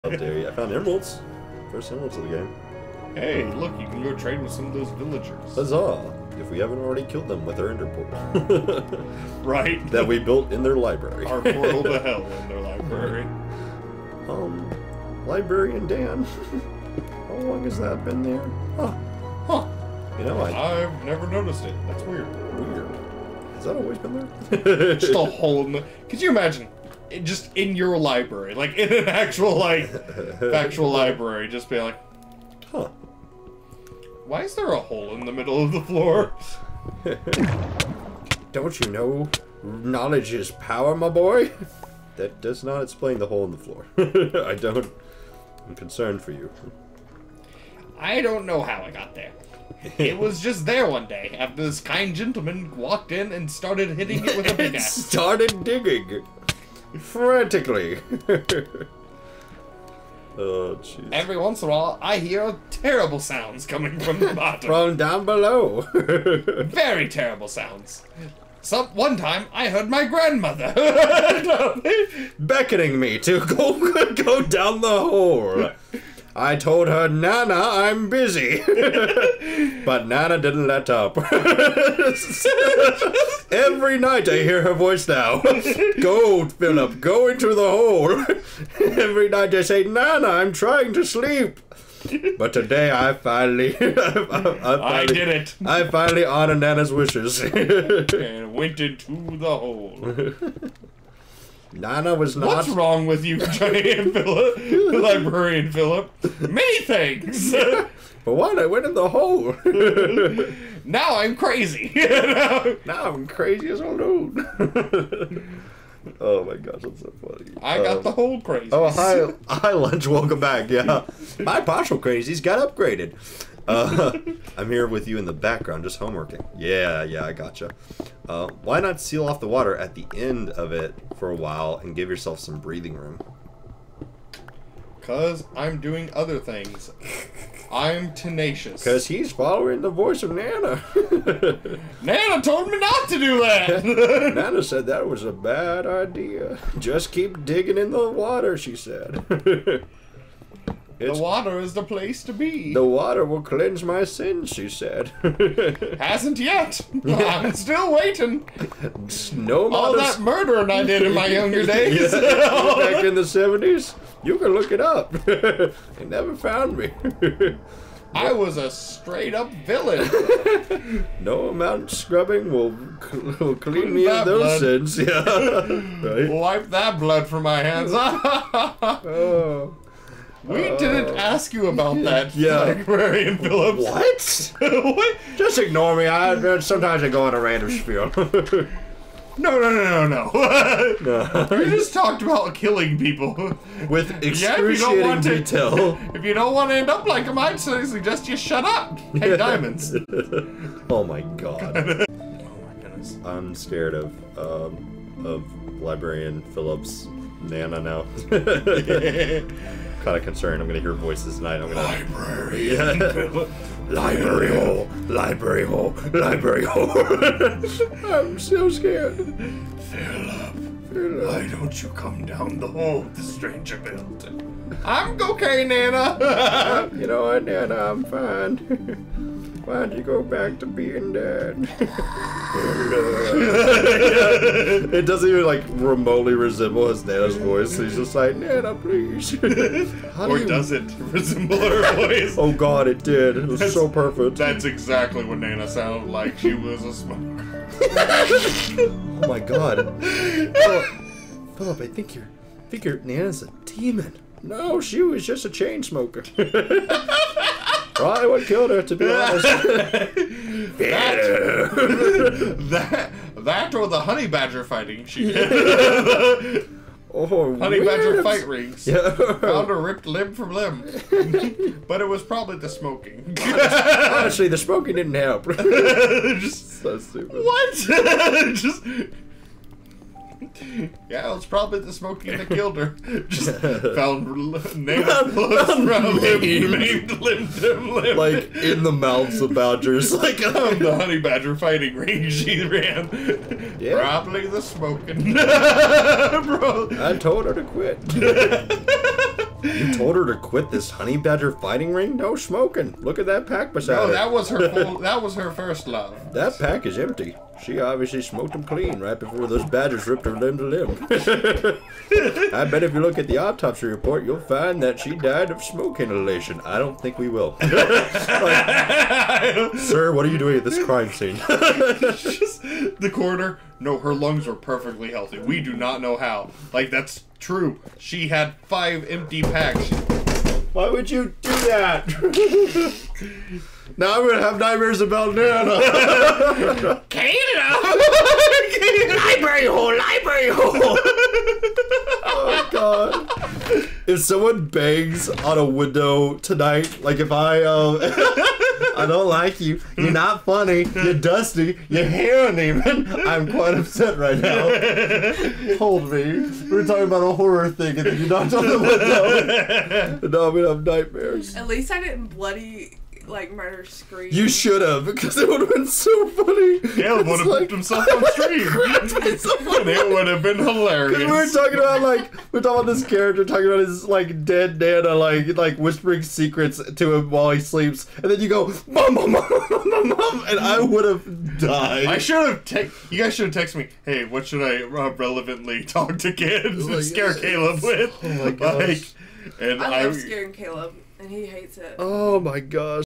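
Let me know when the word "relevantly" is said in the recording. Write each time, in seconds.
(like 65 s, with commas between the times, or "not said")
385 s.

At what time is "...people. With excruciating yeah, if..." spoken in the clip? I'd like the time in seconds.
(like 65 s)
192 s.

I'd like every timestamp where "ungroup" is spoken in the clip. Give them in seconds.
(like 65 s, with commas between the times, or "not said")
not said.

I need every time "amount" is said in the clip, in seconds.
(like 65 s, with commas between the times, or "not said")
171 s.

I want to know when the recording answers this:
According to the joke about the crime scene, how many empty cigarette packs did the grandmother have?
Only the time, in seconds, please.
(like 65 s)
327 s.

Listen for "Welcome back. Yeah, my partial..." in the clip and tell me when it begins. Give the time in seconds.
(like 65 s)
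120 s.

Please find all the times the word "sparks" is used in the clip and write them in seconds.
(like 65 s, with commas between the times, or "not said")
not said.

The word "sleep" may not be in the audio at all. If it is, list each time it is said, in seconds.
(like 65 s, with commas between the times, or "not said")
91 s, 377 s.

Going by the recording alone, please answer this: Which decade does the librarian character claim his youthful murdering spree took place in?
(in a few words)
The 70s.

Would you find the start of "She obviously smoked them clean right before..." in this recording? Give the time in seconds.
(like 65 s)
307 s.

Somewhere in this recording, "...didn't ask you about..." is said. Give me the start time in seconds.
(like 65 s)
180 s.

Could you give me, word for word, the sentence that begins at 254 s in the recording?
No, she was just a chain smoker.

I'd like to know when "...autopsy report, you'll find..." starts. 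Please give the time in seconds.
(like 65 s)
313 s.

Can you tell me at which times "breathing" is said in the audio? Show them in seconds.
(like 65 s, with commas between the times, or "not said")
132 s.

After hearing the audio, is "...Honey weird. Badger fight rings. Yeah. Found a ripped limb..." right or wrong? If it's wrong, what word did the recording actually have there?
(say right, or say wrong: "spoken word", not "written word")
right.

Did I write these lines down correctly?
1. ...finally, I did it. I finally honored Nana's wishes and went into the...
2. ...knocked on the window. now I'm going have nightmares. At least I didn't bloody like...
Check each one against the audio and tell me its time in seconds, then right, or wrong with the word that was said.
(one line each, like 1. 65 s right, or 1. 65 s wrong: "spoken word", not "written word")
1. 94 s right
2. 358 s right.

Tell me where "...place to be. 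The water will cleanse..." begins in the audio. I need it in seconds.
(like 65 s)
151 s.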